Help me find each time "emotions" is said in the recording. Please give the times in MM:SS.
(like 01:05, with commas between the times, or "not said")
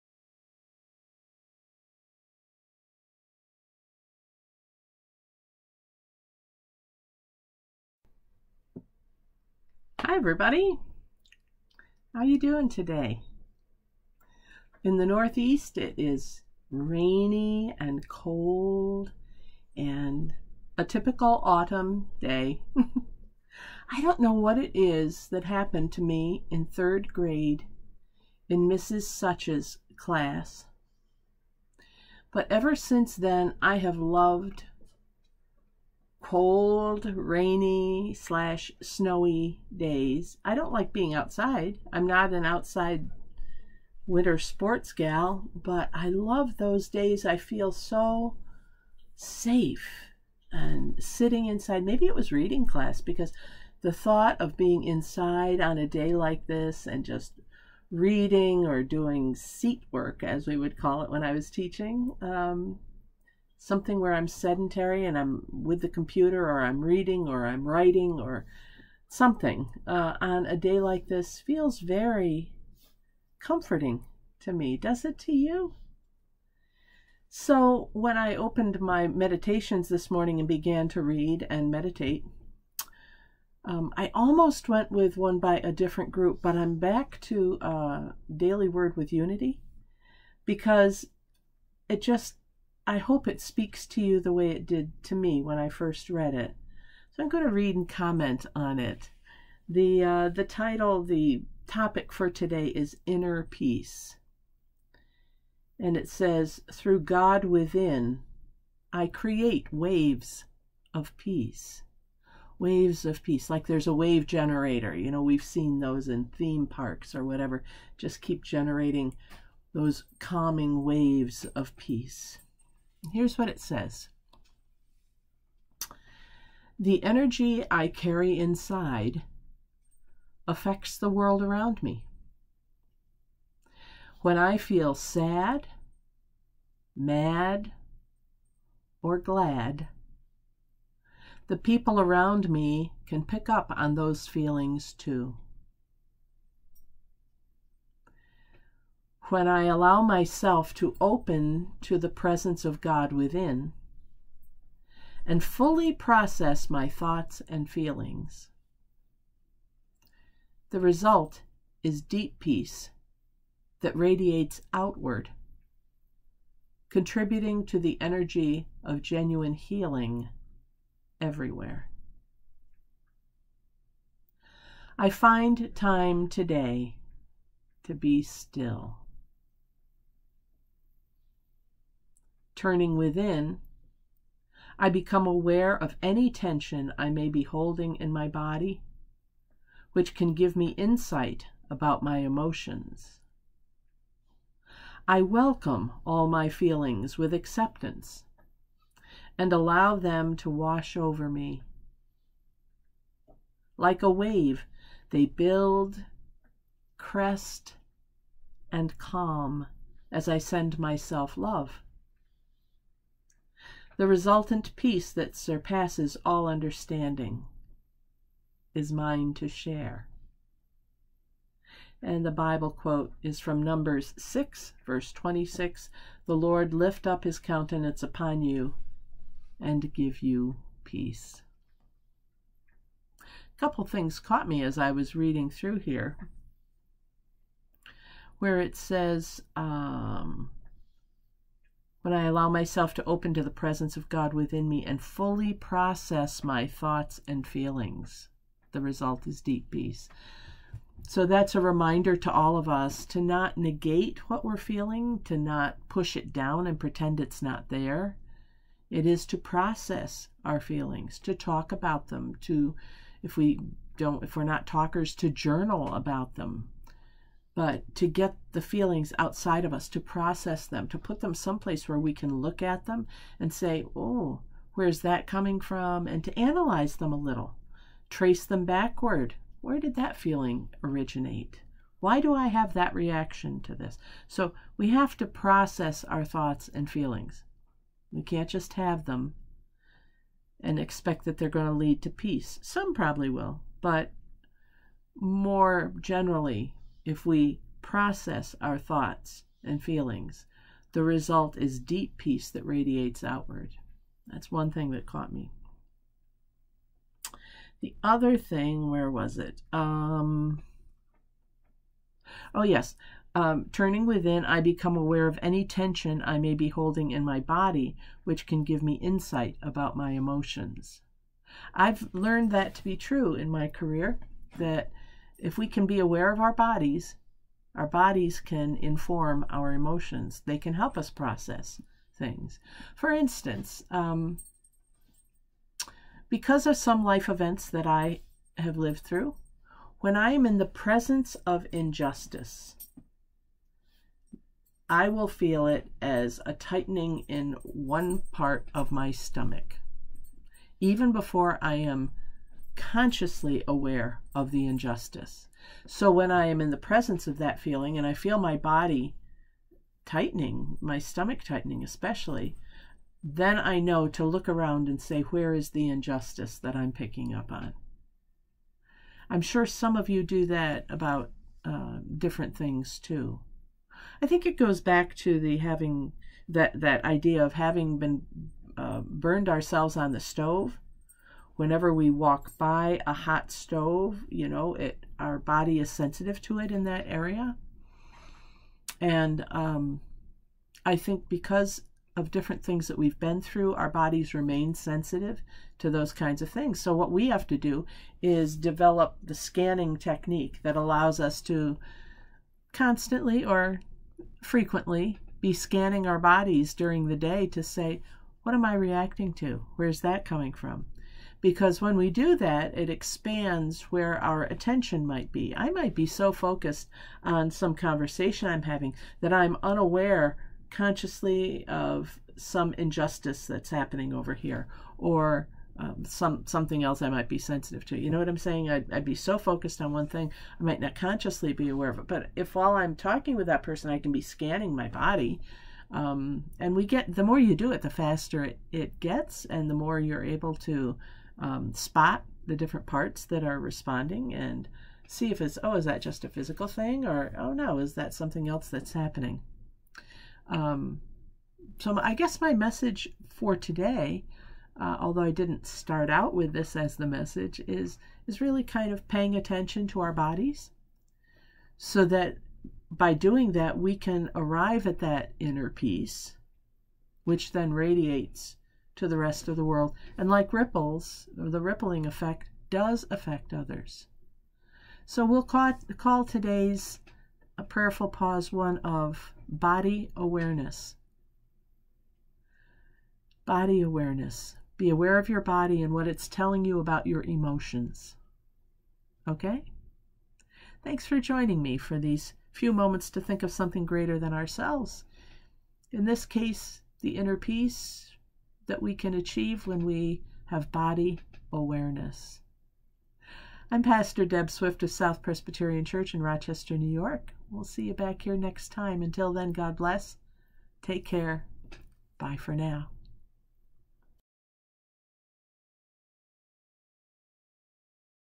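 03:12, 05:20, 05:29, 08:07.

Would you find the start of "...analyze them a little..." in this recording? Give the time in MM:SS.
04:36.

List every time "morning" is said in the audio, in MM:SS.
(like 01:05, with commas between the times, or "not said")
01:20.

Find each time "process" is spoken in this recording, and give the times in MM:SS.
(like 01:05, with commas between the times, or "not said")
02:35, 04:05, 04:19, 04:30, 04:45, 04:57, 05:31.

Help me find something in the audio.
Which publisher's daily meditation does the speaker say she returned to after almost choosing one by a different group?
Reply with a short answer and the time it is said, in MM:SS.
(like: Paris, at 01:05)
Unity, at 01:29.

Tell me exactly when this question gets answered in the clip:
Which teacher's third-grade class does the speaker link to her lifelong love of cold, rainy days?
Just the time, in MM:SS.
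00:28.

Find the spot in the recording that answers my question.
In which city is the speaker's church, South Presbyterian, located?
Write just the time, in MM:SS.
08:26.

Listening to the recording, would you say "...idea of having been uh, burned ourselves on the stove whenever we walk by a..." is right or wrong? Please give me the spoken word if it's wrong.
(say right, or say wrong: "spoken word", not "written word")
right.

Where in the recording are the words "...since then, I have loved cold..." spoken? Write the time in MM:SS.
00:32.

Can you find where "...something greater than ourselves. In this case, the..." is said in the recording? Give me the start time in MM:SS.
08:13.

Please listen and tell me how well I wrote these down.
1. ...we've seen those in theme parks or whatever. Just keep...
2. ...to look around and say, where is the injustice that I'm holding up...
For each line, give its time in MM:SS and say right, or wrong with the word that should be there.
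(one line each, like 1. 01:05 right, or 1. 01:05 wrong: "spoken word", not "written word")
1. 01:55 right
2. 06:04 wrong: "picking", not "holding".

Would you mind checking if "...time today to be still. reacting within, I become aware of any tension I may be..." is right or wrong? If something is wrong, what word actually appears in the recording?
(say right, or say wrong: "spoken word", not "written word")
wrong: "turning", not "reacting".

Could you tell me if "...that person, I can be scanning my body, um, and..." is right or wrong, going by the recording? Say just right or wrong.
right.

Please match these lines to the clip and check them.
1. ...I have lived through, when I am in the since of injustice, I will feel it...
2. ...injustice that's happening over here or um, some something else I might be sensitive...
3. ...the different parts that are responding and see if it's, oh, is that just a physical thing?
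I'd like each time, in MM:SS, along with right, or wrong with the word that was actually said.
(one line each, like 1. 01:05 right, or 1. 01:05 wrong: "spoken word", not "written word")
1. 05:37 wrong: "presence", not "since"
2. 07:02 right
3. 07:22 right.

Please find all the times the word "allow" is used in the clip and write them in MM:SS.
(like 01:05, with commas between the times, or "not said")
02:29, 03:19, 04:02, 06:40.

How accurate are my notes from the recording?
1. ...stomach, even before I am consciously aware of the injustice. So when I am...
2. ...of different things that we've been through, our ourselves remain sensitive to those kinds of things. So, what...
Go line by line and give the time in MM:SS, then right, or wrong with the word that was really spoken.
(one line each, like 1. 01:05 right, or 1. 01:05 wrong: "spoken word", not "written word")
1. 05:49 right
2. 06:32 wrong: "bodies", not "ourselves".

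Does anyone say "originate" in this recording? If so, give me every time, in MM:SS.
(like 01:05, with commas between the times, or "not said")
04:40.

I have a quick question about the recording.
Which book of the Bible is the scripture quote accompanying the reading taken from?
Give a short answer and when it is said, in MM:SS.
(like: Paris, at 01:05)
Numbers, at 03:43.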